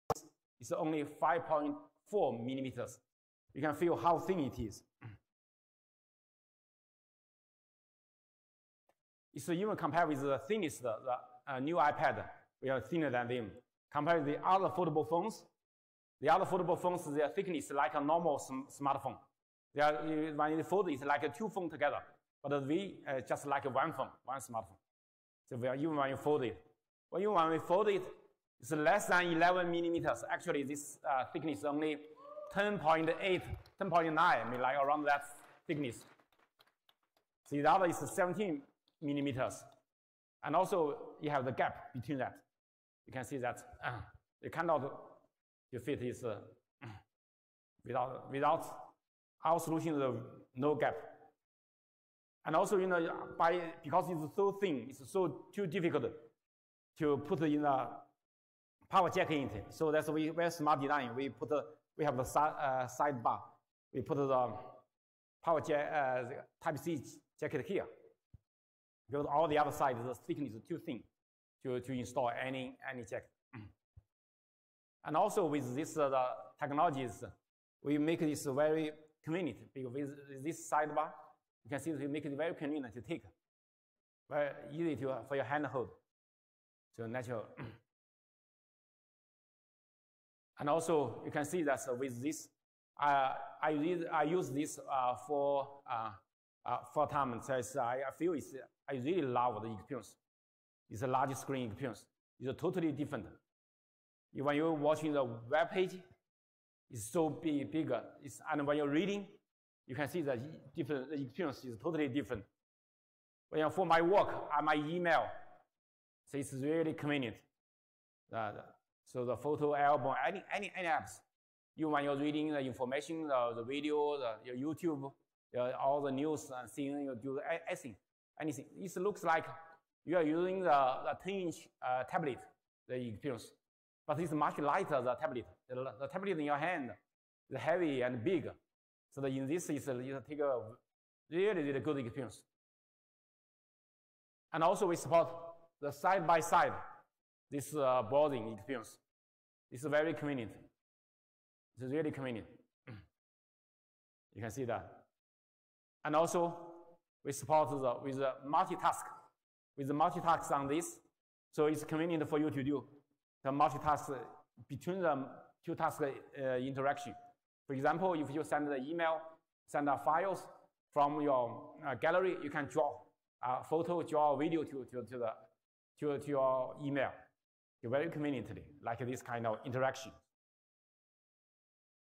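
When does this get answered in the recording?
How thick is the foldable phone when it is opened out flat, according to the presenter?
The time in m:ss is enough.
0:01.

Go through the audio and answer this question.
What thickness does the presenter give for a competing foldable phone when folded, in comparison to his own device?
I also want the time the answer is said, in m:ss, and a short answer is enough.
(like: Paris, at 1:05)
17 millimeters, at 0:37.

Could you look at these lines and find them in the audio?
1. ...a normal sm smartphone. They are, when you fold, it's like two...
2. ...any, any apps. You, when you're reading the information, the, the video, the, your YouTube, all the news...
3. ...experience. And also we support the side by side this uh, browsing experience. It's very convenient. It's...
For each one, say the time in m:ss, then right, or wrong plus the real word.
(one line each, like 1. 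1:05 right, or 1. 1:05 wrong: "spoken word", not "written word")
1. 0:17 right
2. 2:00 right
3. 2:21 right.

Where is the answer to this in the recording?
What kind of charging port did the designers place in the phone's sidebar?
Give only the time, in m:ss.
1:06.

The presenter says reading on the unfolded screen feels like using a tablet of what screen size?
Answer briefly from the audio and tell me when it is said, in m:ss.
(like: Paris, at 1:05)
10 inch, at 2:11.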